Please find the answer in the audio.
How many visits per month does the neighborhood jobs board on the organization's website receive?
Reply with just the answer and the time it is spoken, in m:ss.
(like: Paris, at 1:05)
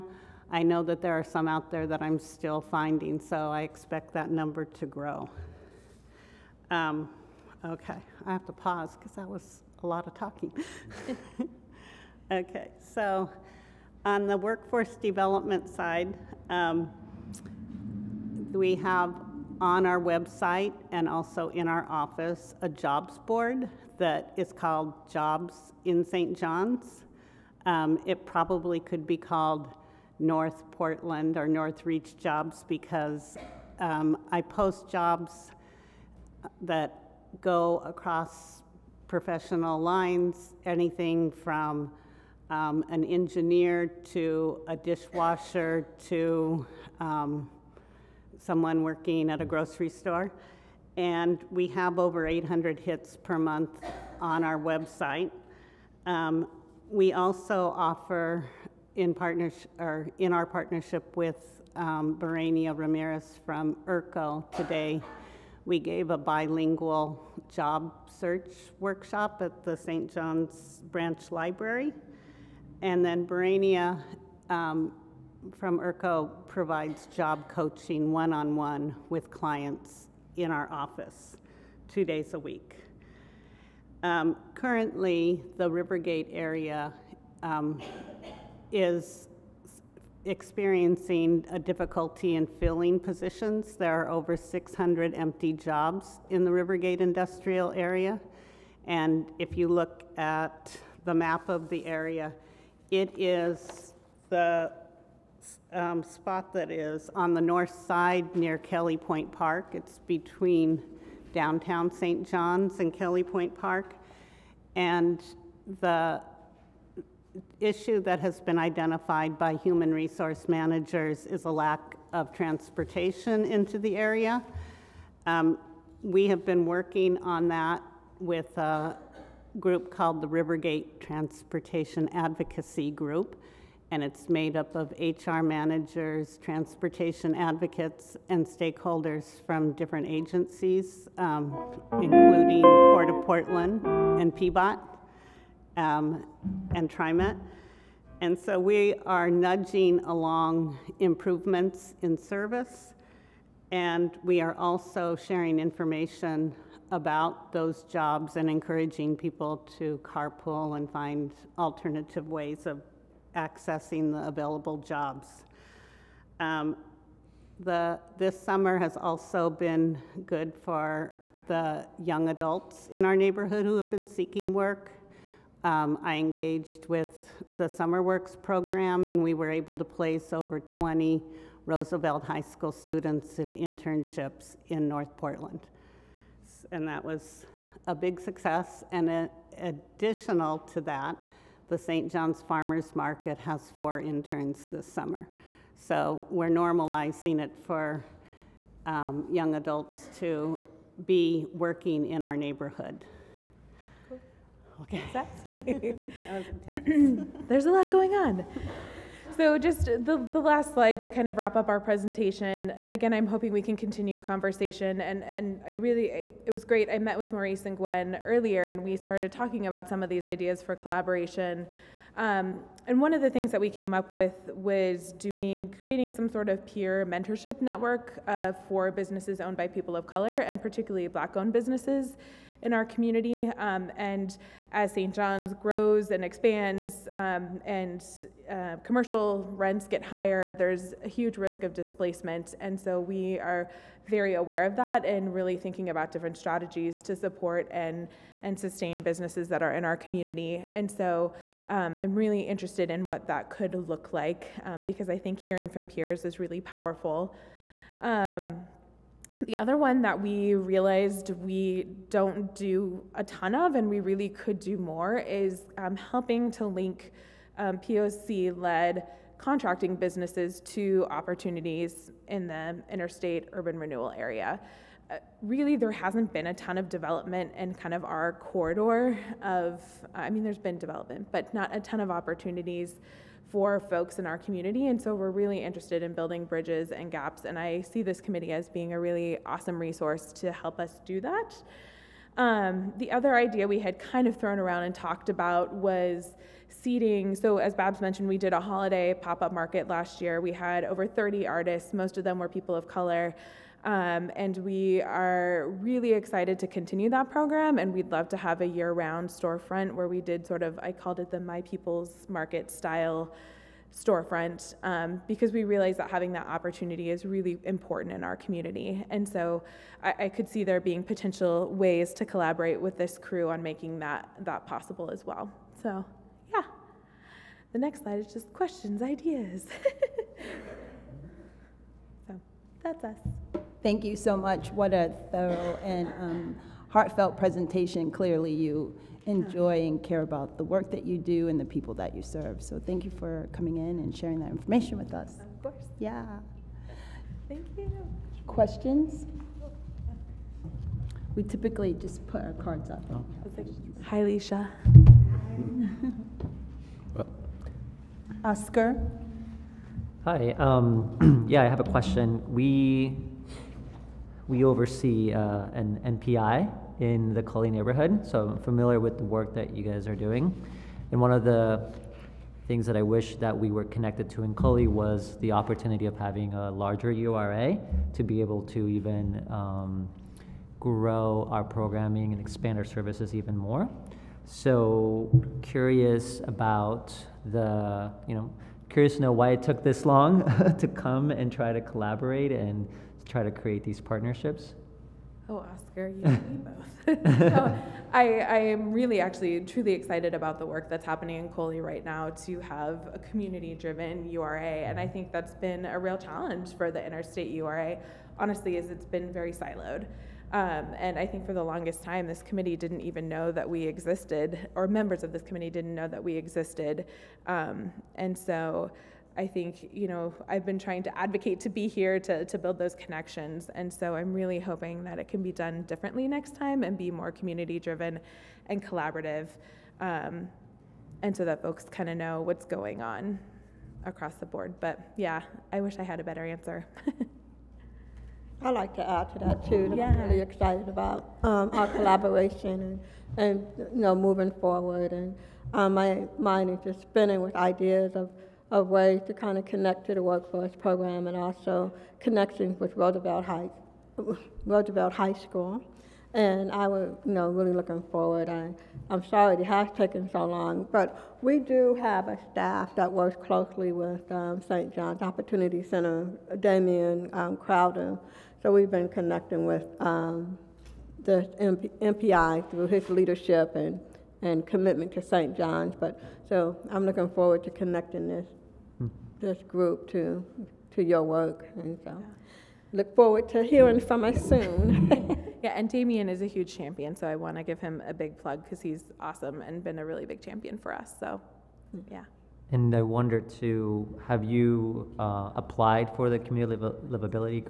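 over 800, at 0:51.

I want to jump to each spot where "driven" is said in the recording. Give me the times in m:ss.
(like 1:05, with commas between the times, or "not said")
6:43, 7:07.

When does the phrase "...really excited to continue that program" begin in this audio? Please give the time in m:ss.
5:05.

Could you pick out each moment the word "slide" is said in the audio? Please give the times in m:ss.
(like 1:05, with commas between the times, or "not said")
3:30, 5:28.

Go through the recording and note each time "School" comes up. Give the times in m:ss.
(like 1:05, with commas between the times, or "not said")
3:02, 7:35.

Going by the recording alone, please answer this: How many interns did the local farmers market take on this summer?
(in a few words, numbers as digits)
4.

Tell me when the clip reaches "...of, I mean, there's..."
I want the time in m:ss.
4:39.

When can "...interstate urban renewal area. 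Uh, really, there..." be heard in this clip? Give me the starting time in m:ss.
4:32.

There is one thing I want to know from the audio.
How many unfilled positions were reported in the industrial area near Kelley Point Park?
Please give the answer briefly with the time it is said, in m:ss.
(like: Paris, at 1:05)
over 600, at 1:34.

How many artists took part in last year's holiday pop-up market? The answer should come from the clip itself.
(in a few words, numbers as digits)
over 30.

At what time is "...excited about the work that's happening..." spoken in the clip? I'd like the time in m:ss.
6:39.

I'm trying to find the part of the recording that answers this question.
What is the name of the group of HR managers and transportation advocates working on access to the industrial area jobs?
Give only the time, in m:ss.
2:10.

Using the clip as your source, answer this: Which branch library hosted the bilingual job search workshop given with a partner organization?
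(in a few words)
St. John's Branch Library.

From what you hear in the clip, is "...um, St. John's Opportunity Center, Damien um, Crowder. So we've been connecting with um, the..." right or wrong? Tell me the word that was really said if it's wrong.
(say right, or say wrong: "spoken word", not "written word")
right.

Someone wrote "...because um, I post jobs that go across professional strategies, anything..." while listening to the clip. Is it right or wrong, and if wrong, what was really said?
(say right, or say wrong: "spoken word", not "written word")
wrong: "lines", not "strategies".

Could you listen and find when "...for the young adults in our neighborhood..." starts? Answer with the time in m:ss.
2:50.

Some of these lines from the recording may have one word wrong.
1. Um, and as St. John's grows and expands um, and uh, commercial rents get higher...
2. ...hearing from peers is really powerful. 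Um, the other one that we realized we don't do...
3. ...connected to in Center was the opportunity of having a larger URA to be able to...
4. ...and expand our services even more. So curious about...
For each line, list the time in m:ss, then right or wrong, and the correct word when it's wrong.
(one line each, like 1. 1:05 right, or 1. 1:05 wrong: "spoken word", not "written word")
1. 3:53 right
2. 4:15 right
3. 6:13 wrong: "Cully", not "Center"
4. 6:22 right.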